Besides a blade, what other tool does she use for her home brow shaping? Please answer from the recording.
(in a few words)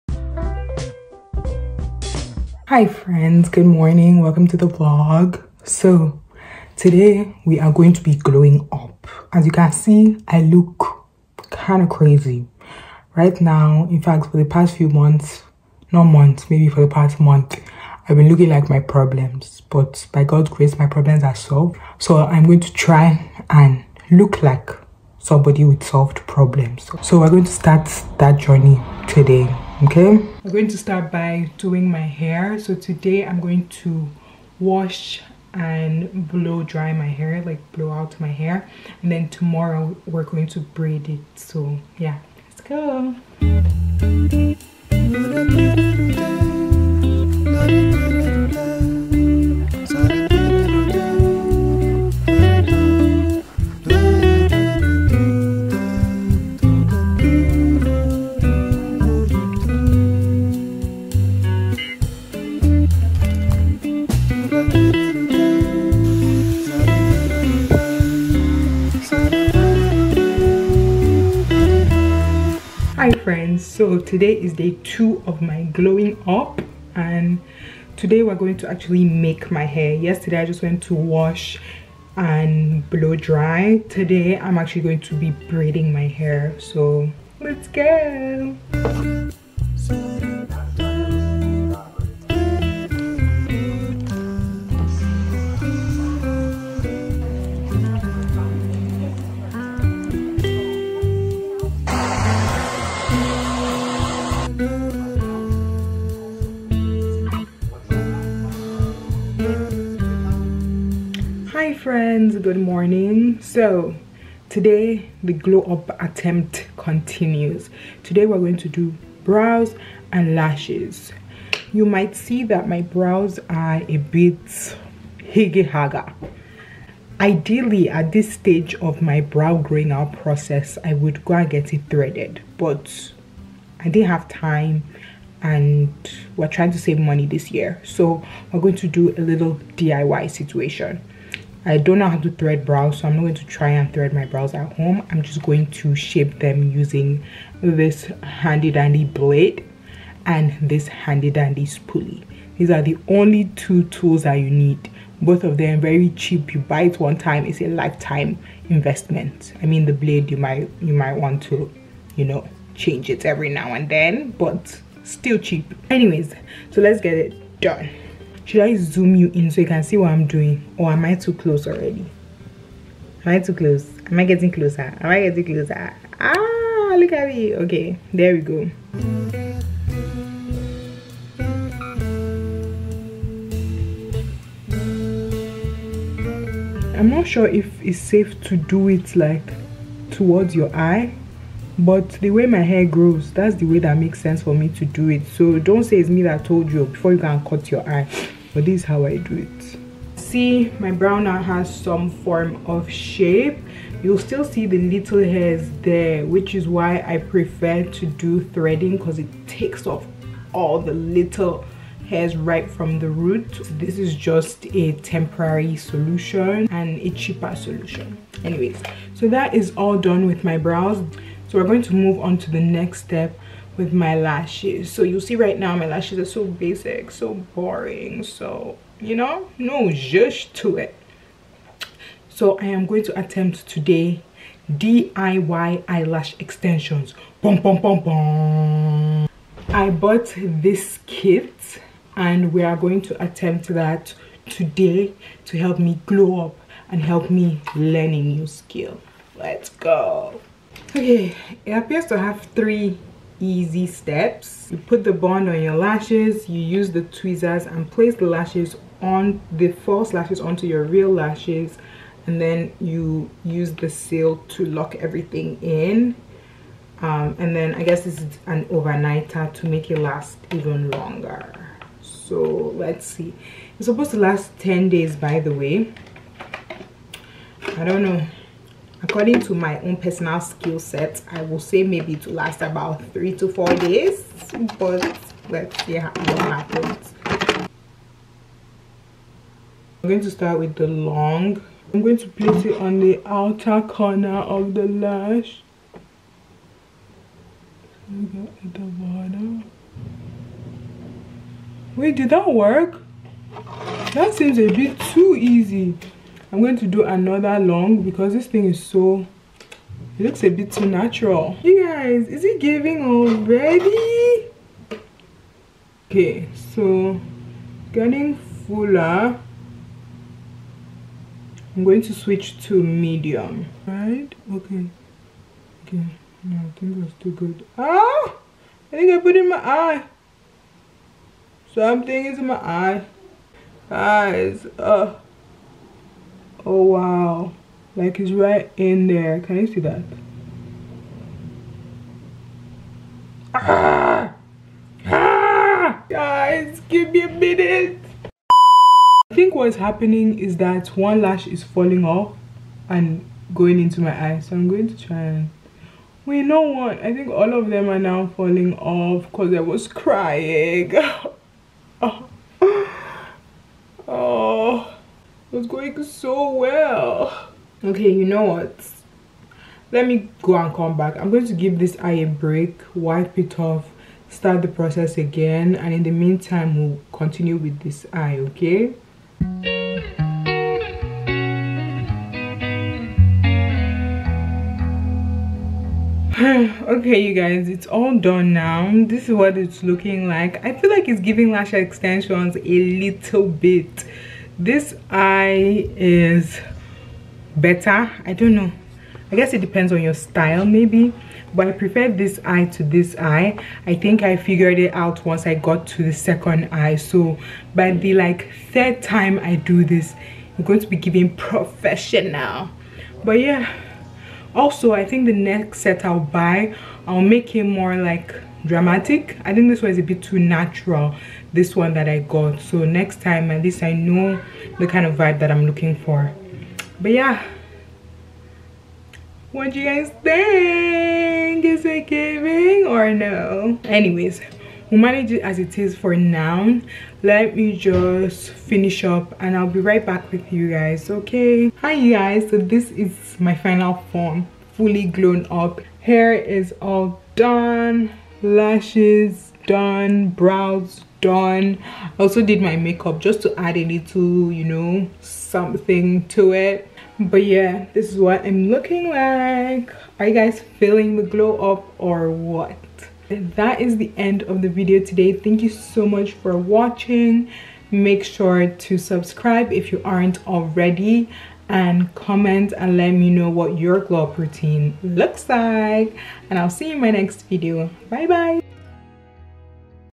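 Spoolie.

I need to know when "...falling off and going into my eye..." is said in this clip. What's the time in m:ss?
5:51.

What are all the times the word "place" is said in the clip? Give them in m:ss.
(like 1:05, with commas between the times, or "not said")
4:17, 4:52.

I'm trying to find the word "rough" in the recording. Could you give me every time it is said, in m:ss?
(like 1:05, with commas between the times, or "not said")
not said.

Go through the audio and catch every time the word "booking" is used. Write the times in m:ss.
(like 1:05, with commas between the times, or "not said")
not said.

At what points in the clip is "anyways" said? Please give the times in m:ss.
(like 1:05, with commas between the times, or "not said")
2:45, 3:38, 7:13.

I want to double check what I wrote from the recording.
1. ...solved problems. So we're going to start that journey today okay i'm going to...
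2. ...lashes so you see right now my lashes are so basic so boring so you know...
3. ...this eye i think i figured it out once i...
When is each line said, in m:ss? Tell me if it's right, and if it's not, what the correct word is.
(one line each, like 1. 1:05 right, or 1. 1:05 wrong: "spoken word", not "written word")
1. 0:25 right
2. 3:44 right
3. 6:42 right.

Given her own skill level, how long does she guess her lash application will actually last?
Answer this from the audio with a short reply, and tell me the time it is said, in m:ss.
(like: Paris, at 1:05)
3 to 4 days, at 4:43.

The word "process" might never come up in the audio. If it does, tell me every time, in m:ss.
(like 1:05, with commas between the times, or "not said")
2:10, 6:14.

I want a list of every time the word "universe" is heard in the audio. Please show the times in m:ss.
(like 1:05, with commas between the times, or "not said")
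not said.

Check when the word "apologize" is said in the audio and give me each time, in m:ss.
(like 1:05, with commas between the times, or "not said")
not said.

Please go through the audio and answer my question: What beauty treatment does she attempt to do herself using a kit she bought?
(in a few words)
DIY eyelash extensions.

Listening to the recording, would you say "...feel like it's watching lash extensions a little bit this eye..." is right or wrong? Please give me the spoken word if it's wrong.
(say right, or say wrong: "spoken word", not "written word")
wrong: "giving", not "watching".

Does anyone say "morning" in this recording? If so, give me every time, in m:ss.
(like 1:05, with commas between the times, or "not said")
0:03, 1:52.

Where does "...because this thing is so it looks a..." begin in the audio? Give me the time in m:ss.
5:08.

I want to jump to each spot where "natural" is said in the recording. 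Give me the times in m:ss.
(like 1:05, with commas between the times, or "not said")
5:10, 7:00.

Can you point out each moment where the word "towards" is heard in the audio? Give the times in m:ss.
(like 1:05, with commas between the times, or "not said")
3:10.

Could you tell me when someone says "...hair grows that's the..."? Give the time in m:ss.
3:12.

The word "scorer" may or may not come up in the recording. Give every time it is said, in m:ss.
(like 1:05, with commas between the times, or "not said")
not said.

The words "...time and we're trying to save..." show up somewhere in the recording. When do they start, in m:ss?
2:14.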